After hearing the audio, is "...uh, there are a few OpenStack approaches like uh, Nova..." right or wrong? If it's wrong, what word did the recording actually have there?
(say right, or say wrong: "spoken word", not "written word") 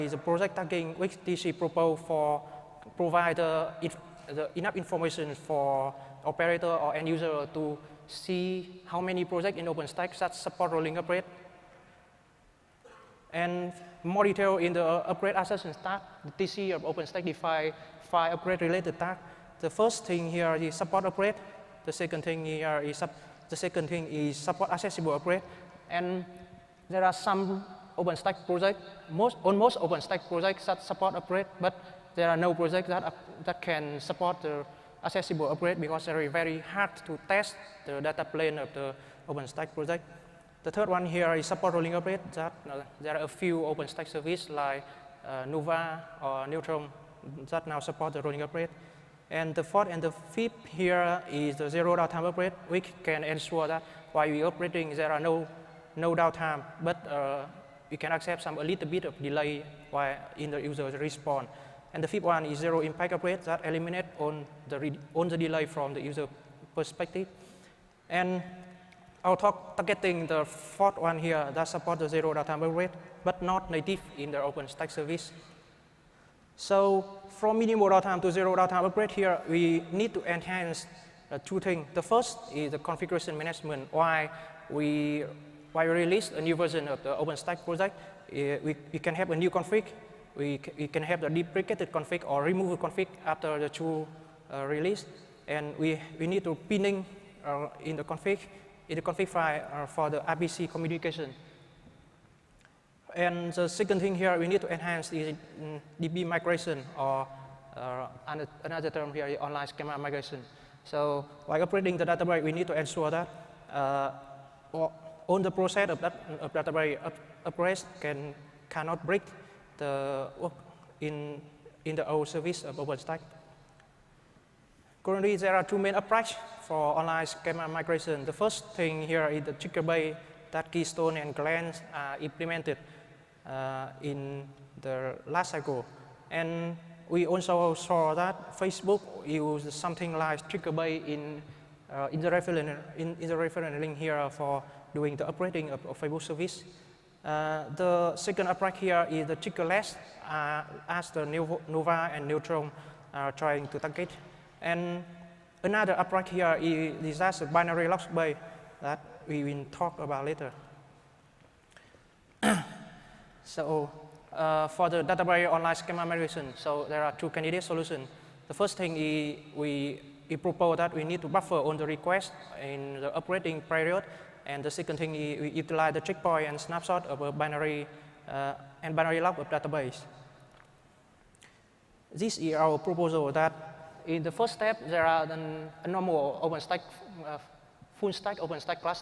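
wrong: "services", not "approaches".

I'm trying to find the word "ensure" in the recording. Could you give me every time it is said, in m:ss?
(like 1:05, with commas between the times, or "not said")
0:53, 1:52.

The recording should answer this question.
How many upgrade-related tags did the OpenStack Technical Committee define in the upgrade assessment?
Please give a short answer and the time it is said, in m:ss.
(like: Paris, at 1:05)
5, at 0:18.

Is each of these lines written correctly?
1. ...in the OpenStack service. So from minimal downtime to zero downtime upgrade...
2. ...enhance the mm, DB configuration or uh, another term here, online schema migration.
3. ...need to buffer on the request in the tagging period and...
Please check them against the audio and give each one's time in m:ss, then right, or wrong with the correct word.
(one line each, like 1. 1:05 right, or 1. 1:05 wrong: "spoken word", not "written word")
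1. 1:14 right
2. 1:44 wrong: "migration", not "configuration"
3. 2:51 wrong: "operating", not "tagging".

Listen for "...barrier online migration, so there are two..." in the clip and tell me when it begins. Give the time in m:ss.
2:45.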